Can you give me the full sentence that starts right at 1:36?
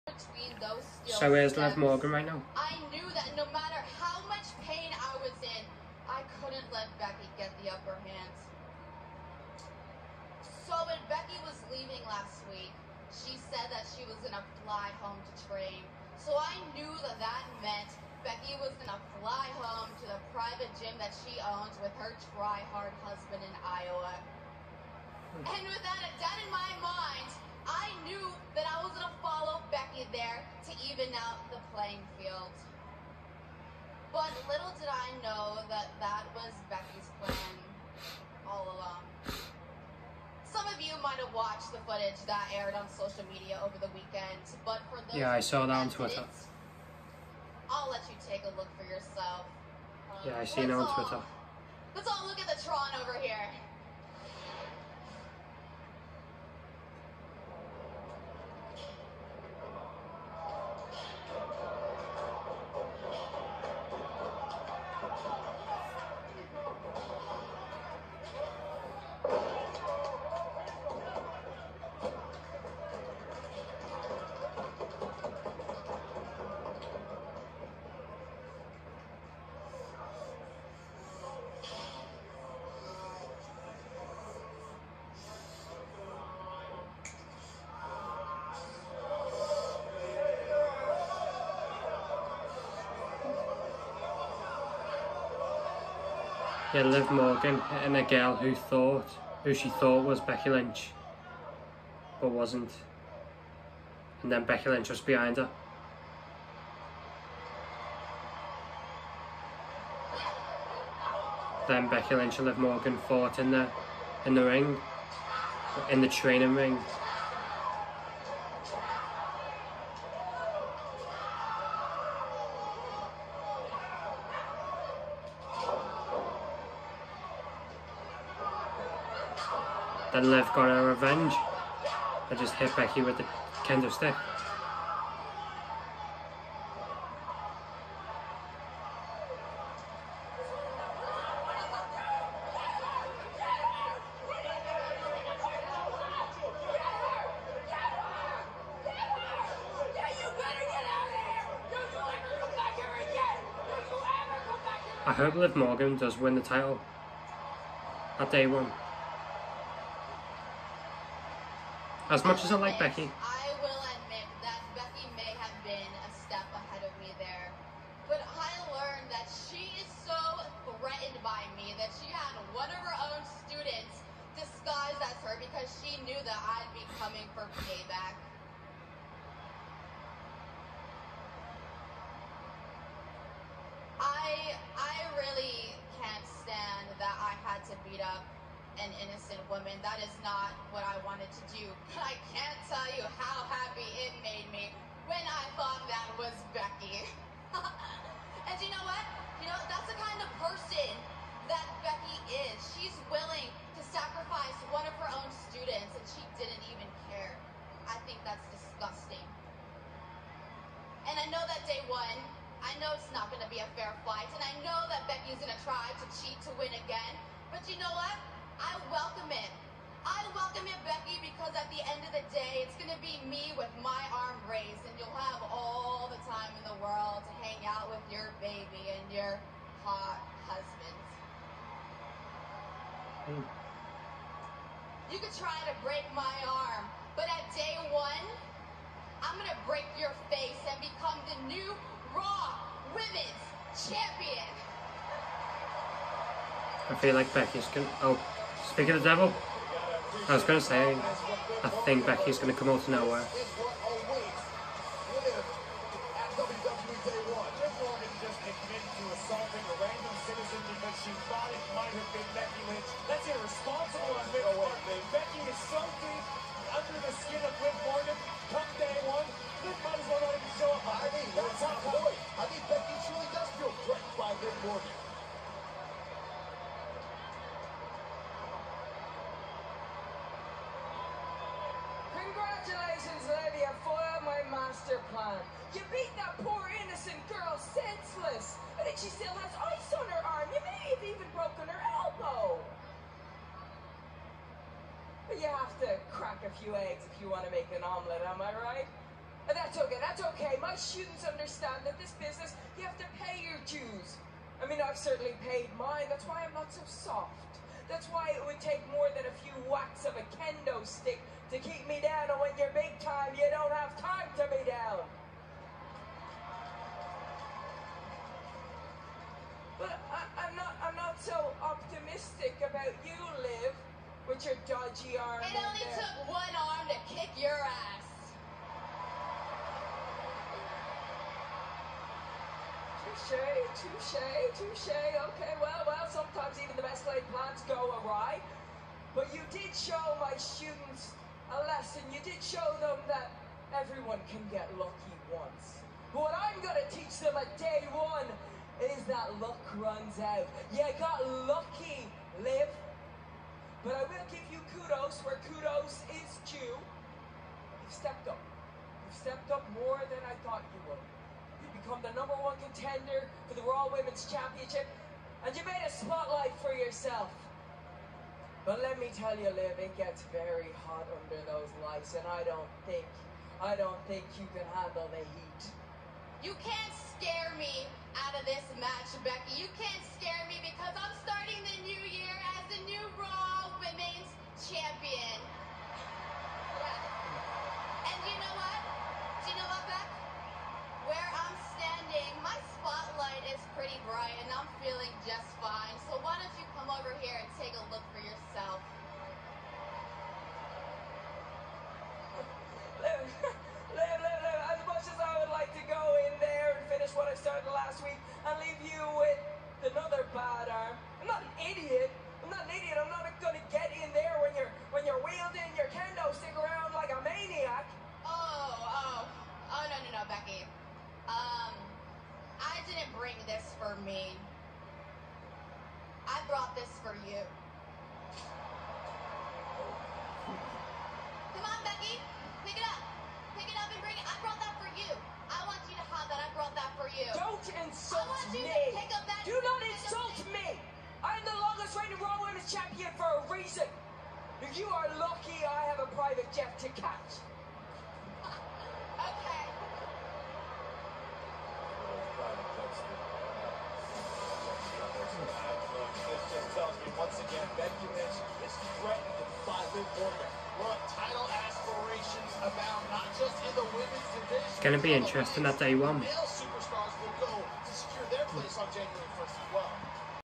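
Yeah, Liv Morgan and a girl who thought, who she thought was Becky Lynch, but wasn't.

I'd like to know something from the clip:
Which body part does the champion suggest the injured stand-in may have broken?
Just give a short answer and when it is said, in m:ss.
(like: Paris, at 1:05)
Elbow, at 4:51.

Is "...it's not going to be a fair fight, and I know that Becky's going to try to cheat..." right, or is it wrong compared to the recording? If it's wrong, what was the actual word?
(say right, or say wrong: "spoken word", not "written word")
right.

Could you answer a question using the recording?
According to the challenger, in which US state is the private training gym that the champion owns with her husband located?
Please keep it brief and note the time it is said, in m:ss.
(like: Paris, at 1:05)
Iowa, at 0:23.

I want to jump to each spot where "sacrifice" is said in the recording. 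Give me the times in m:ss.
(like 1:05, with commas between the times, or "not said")
3:23.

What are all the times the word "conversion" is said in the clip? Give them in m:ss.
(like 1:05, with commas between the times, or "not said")
not said.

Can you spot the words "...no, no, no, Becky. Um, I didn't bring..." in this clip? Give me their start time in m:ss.
6:59.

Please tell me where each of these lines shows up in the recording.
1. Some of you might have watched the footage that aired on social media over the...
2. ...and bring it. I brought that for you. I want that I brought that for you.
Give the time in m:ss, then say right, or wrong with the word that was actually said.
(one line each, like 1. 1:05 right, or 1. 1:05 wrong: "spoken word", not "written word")
1. 0:40 right
2. 7:13 right.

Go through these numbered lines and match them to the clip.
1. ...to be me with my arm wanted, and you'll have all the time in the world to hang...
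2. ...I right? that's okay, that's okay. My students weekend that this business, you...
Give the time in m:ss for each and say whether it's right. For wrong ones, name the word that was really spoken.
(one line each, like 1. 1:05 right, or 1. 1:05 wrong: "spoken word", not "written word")
1. 3:42 wrong: "raised", not "wanted"
2. 4:58 wrong: "understand", not "weekend".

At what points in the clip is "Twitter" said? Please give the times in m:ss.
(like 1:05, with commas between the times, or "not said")
0:45, 0:50.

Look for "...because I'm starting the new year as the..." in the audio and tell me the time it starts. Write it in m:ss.
6:20.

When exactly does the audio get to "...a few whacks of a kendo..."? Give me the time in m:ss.
5:09.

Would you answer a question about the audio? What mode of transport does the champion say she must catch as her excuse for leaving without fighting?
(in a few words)
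Private jet.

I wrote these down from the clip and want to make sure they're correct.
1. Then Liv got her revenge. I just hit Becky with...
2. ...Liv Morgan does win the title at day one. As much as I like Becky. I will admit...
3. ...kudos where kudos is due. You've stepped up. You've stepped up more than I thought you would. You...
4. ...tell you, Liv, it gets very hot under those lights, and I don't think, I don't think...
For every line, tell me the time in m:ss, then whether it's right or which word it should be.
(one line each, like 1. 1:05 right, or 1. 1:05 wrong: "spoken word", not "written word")
1. 2:10 right
2. 2:35 right
3. 5:54 right
4. 6:09 right.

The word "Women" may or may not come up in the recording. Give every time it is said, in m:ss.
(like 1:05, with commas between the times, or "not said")
4:02, 6:03, 7:22.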